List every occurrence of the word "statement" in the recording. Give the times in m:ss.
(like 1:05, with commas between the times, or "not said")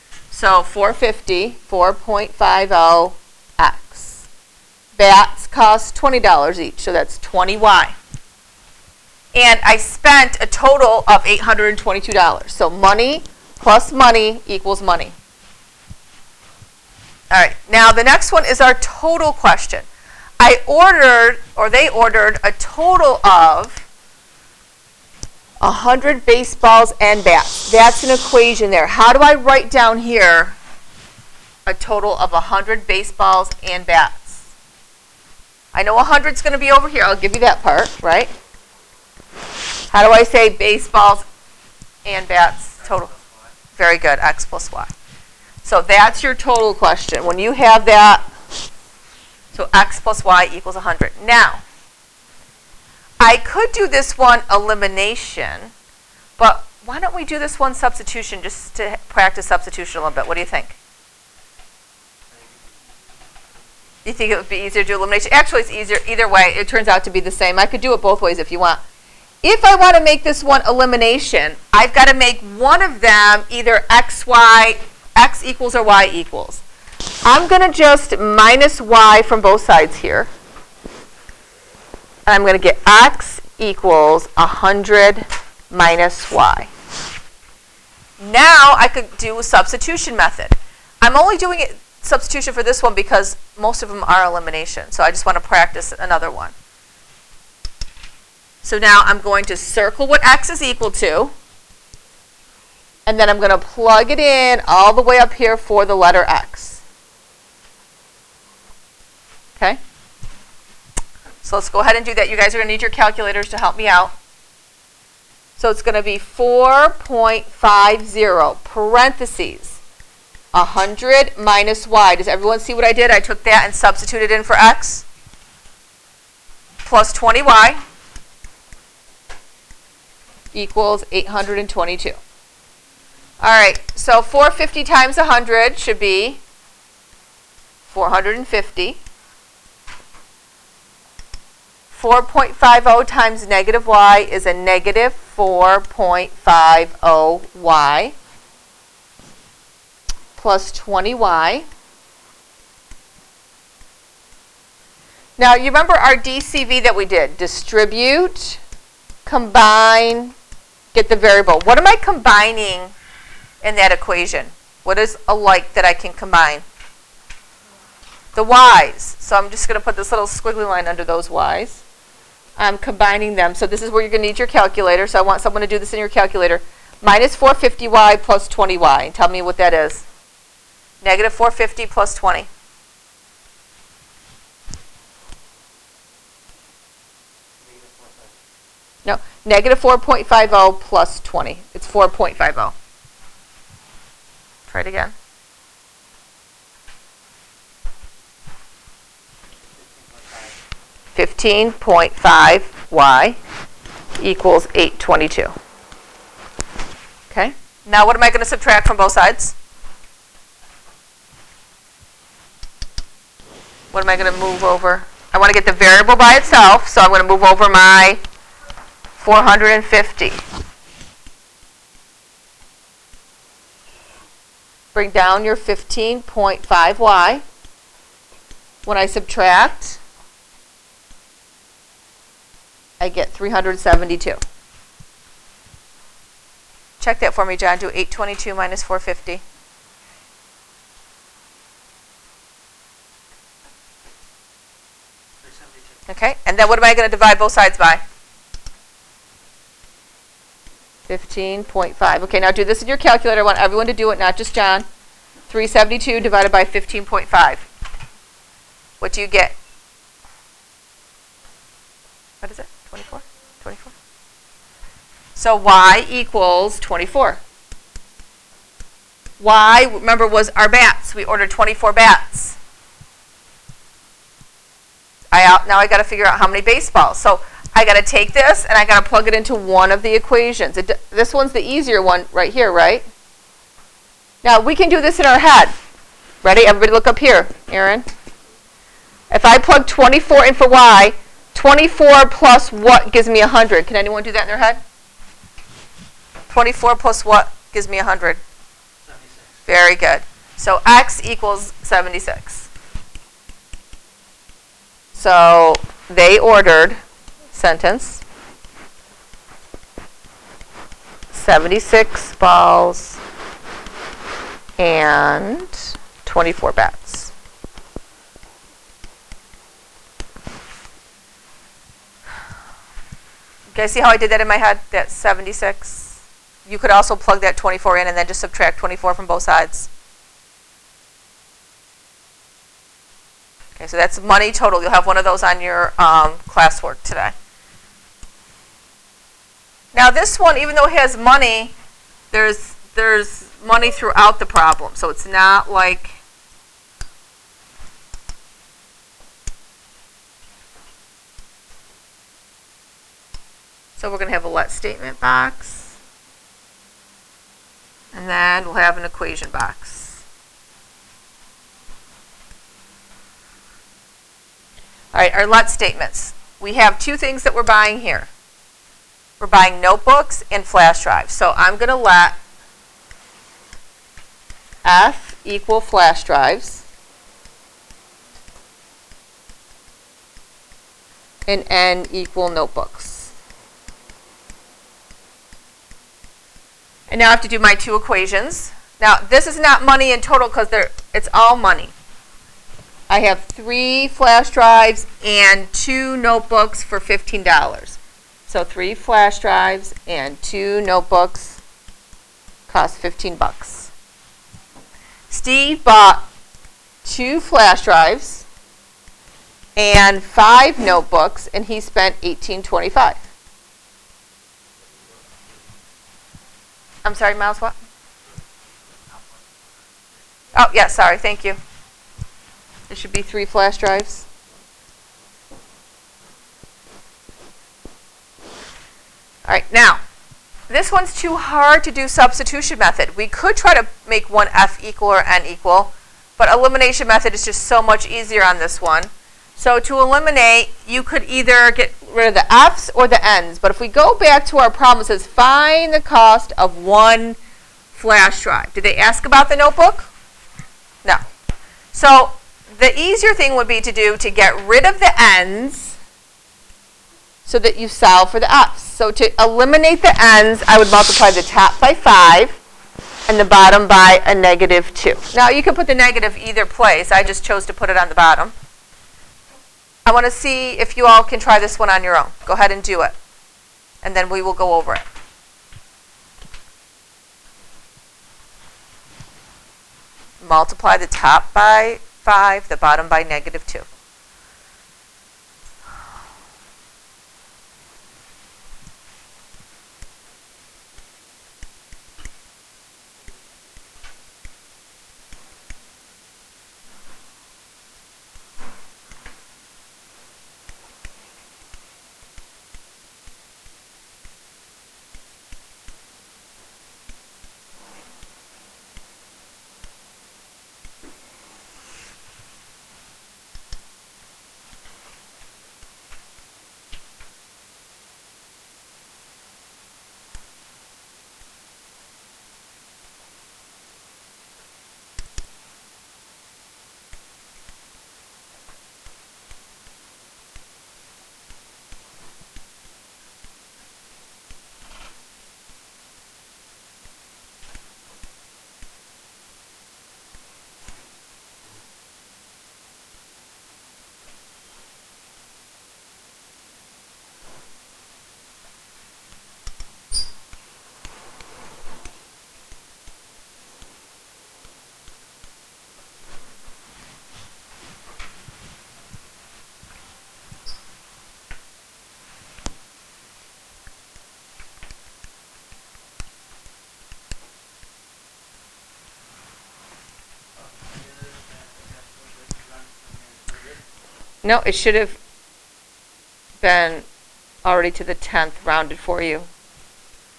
5:54, 6:05.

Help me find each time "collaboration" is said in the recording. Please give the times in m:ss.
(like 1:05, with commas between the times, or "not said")
not said.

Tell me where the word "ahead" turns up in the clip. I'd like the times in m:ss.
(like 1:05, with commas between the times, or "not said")
1:51, 7:52.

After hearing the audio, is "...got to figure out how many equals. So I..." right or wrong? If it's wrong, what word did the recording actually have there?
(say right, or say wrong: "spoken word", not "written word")
wrong: "baseballs", not "equals".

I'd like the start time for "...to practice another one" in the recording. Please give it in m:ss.
1:35.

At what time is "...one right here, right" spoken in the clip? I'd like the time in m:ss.
4:42.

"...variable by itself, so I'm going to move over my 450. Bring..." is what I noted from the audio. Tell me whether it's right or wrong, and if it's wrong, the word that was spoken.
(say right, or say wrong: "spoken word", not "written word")
right.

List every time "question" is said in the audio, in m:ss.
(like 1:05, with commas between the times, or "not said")
0:19, 0:46.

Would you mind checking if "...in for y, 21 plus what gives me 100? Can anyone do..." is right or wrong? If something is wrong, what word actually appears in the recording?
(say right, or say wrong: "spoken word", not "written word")
wrong: "24", not "21".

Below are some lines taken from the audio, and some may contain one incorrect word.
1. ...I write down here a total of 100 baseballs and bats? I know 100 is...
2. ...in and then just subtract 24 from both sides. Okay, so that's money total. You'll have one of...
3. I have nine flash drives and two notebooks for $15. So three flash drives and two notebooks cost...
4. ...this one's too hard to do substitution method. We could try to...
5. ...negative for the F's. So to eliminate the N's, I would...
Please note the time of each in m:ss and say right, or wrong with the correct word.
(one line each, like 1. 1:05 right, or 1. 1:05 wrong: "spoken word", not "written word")
1. 0:29 right
2. 5:27 right
3. 6:33 wrong: "three", not "nine"
4. 7:10 right
5. 7:37 wrong: "solve", not "negative".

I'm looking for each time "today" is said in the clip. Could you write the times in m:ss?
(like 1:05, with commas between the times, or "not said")
5:37.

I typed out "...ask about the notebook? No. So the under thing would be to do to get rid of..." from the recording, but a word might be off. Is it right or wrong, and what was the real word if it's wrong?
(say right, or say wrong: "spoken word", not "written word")
wrong: "easier", not "under".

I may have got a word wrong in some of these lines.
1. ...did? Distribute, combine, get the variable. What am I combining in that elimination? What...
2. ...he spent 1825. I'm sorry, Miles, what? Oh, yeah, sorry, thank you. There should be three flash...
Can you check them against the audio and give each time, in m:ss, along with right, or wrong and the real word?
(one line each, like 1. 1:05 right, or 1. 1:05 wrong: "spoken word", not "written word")
1. 2:37 wrong: "equation", not "elimination"
2. 6:51 right.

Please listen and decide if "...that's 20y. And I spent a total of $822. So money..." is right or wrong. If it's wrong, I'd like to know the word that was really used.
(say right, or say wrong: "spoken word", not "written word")
right.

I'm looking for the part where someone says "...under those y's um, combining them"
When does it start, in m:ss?
2:50.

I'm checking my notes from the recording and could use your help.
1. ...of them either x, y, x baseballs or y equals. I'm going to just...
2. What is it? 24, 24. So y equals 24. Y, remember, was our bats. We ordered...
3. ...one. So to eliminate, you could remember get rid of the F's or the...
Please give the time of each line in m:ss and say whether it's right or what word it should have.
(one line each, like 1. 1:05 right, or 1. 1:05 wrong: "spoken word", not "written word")
1. 1:12 wrong: "equals", not "baseballs"
2. 4:22 right
3. 7:18 wrong: "either", not "remember".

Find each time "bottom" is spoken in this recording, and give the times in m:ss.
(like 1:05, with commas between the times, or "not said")
7:43, 7:48, 8:02.